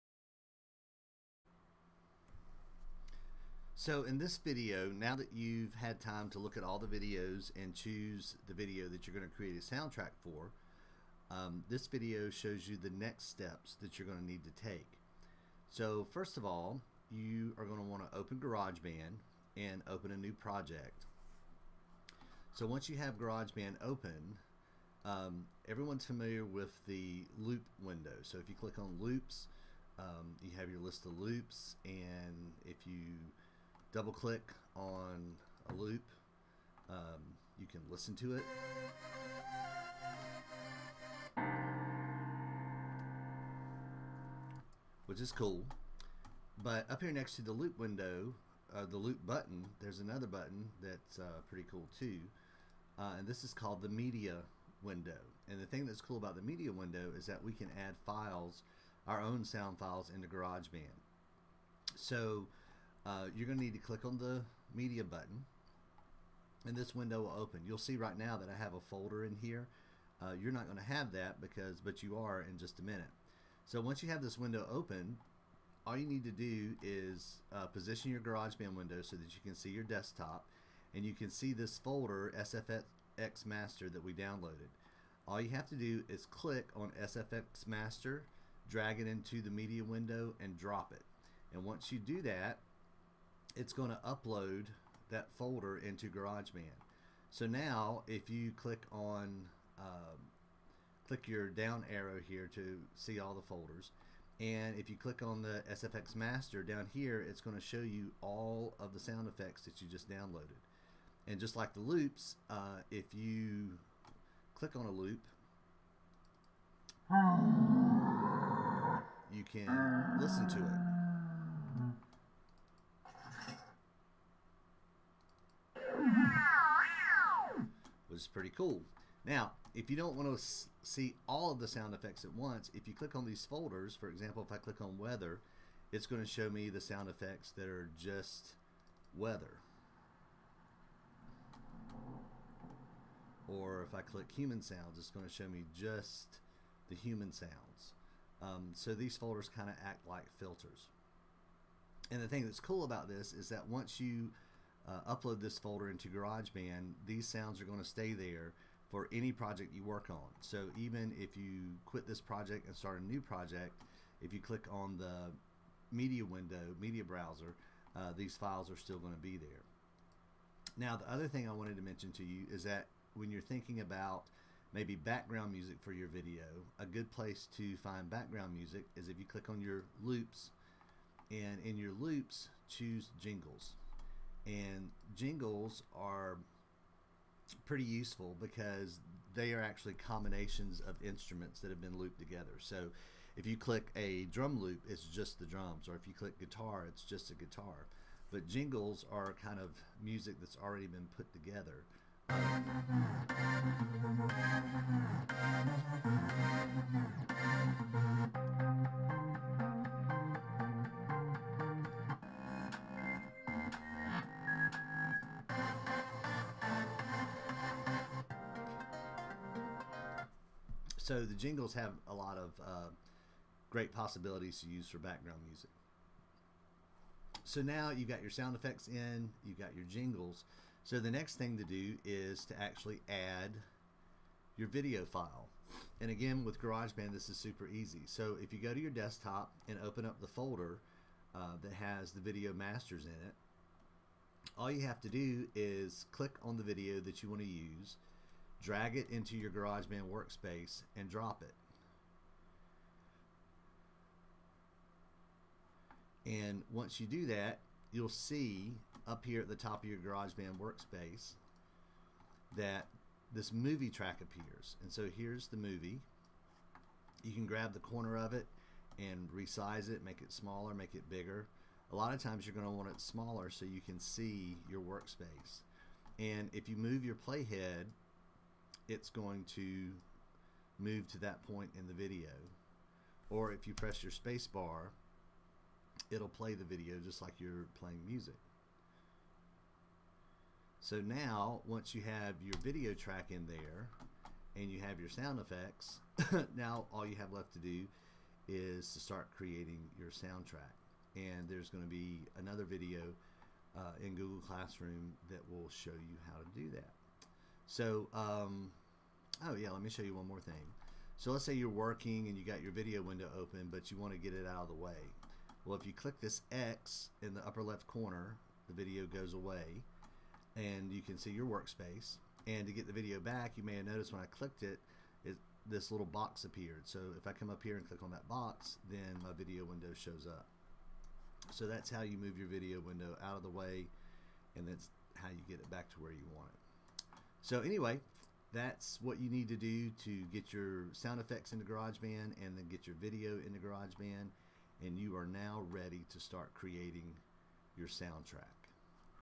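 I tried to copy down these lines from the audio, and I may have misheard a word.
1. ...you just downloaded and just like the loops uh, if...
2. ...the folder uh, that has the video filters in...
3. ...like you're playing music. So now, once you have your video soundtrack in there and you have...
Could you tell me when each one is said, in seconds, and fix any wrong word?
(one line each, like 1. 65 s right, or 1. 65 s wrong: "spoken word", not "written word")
1. 109 s right
2. 240 s wrong: "masters", not "filters"
3. 287 s wrong: "track", not "soundtrack".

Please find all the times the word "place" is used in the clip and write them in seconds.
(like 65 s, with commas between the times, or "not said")
177 s.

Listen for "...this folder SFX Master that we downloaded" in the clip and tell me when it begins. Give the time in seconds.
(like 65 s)
81 s.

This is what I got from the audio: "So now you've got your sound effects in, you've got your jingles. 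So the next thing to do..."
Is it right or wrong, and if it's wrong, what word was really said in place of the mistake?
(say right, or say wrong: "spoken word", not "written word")
right.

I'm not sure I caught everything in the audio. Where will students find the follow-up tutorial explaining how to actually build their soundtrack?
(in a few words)
Google Classroom.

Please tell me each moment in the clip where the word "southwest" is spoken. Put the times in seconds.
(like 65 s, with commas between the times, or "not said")
not said.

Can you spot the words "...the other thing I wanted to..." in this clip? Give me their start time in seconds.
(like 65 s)
170 s.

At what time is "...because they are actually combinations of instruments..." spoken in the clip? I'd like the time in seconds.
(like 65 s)
188 s.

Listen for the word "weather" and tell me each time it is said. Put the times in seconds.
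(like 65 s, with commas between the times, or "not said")
134 s, 139 s.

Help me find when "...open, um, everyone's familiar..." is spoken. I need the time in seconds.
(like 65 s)
23 s.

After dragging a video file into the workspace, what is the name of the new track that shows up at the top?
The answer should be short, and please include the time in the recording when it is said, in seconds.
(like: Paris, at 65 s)
Movie track, at 263 s.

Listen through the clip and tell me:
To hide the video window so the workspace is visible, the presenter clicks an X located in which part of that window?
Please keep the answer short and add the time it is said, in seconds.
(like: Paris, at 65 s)
Upper left corner, at 317 s.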